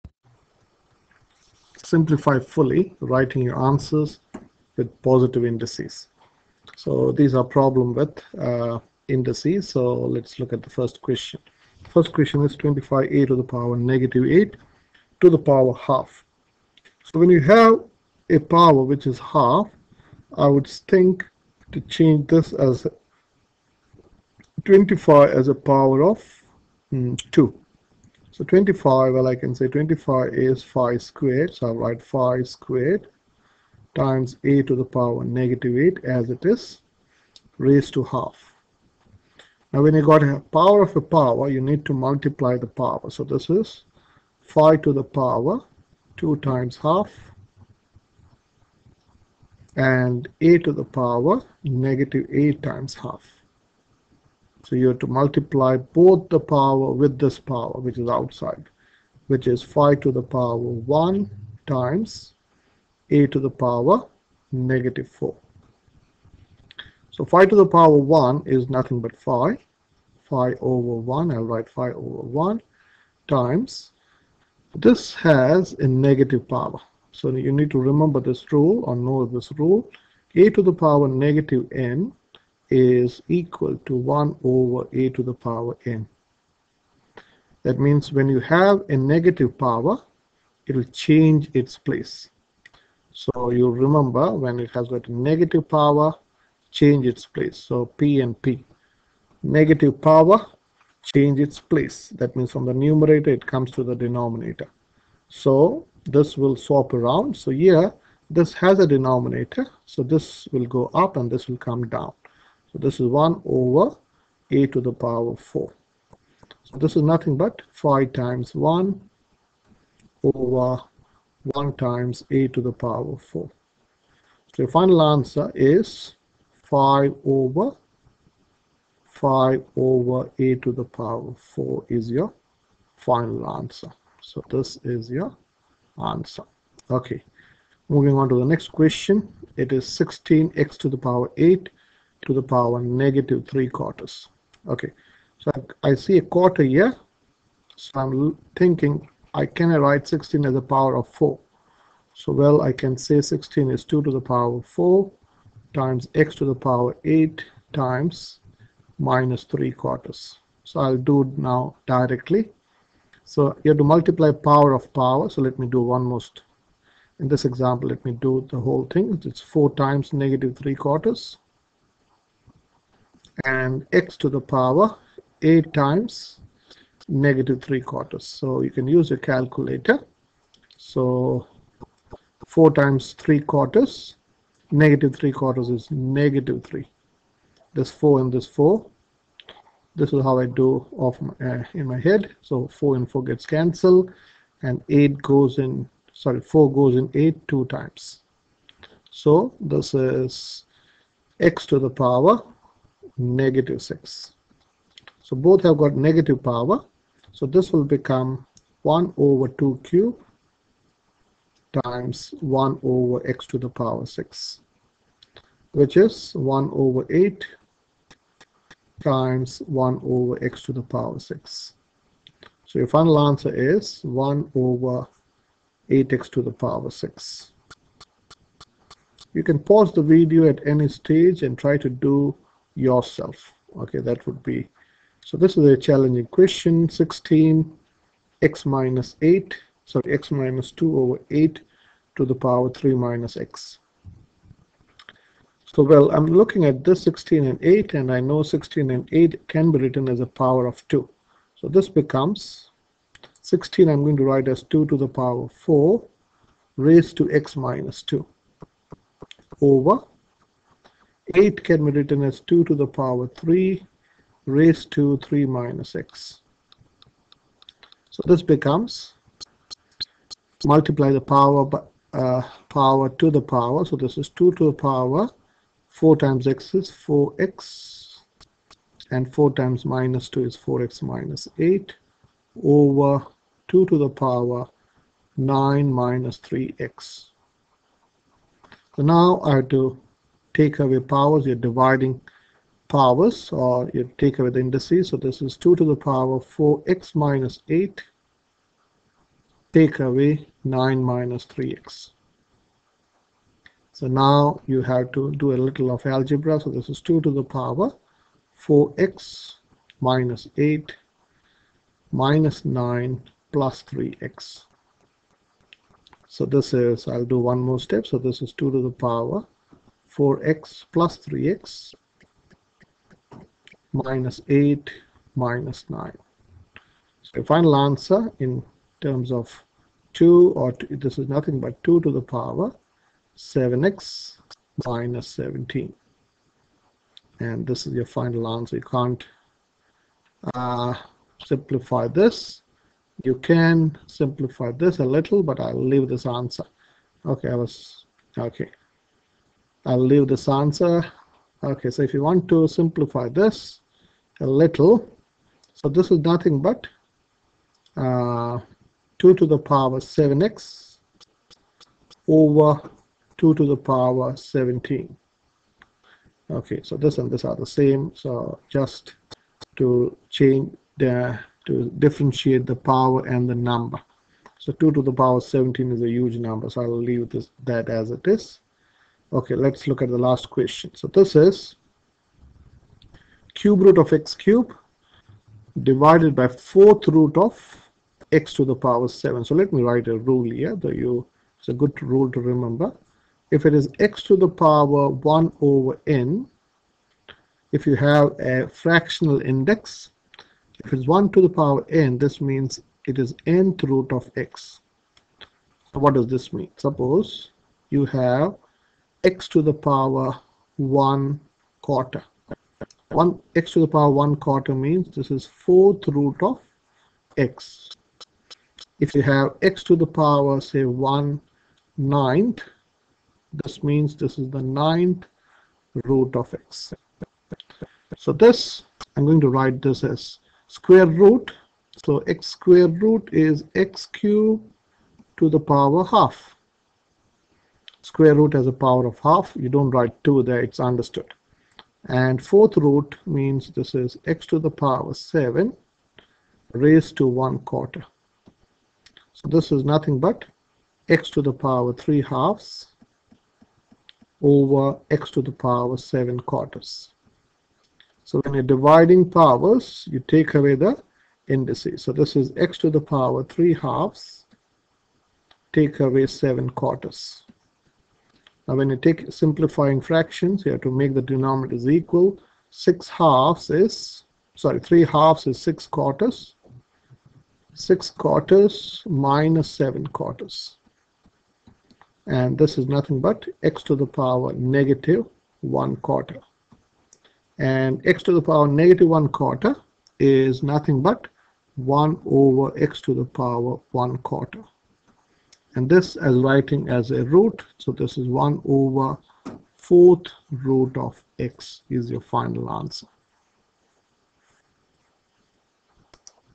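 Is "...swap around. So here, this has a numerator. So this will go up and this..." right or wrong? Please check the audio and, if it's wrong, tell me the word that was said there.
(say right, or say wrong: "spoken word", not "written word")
wrong: "denominator", not "numerator".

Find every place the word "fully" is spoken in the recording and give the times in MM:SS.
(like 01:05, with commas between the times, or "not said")
00:02.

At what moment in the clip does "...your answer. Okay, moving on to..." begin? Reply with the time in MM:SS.
02:15.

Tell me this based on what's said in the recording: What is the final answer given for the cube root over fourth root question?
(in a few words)
1 over fourth root of x.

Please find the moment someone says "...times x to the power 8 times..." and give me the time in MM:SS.
02:35.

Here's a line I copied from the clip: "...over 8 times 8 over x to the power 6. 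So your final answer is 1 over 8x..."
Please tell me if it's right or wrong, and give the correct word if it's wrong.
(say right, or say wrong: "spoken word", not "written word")
wrong: "1", not "8".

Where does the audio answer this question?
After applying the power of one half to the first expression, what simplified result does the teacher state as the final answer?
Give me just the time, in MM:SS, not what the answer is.
02:09.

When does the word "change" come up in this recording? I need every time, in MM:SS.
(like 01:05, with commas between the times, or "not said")
00:21, 01:30, 01:36, 01:41, 06:10.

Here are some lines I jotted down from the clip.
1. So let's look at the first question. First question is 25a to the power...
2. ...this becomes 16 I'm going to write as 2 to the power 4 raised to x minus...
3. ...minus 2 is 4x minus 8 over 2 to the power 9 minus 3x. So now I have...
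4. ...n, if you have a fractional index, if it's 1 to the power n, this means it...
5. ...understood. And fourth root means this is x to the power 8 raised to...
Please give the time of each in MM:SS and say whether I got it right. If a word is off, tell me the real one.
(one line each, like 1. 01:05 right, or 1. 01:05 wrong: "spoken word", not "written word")
1. 00:09 right
2. 04:11 right
3. 04:39 right
4. 06:36 right
5. 07:20 wrong: "7", not "8".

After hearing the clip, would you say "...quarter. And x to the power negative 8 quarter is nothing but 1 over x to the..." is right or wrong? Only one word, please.
wrong.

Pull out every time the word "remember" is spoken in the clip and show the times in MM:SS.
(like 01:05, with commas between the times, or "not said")
01:17, 01:33, 06:32.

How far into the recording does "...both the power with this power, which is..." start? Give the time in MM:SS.
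00:55.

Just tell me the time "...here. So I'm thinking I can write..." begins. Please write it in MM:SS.
02:26.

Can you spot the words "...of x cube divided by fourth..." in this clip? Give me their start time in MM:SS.
06:23.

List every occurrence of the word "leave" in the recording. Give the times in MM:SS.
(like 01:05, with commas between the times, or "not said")
05:45, 05:50, 06:17.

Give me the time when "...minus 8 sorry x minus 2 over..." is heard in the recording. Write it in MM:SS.
03:58.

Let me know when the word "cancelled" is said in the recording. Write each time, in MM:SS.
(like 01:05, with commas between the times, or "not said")
03:13.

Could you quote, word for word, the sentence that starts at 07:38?
So when you're dividing powers, you take away the indices.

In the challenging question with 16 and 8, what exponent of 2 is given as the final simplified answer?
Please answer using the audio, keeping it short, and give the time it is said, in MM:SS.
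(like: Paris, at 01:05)
7x minus 17, at 05:33.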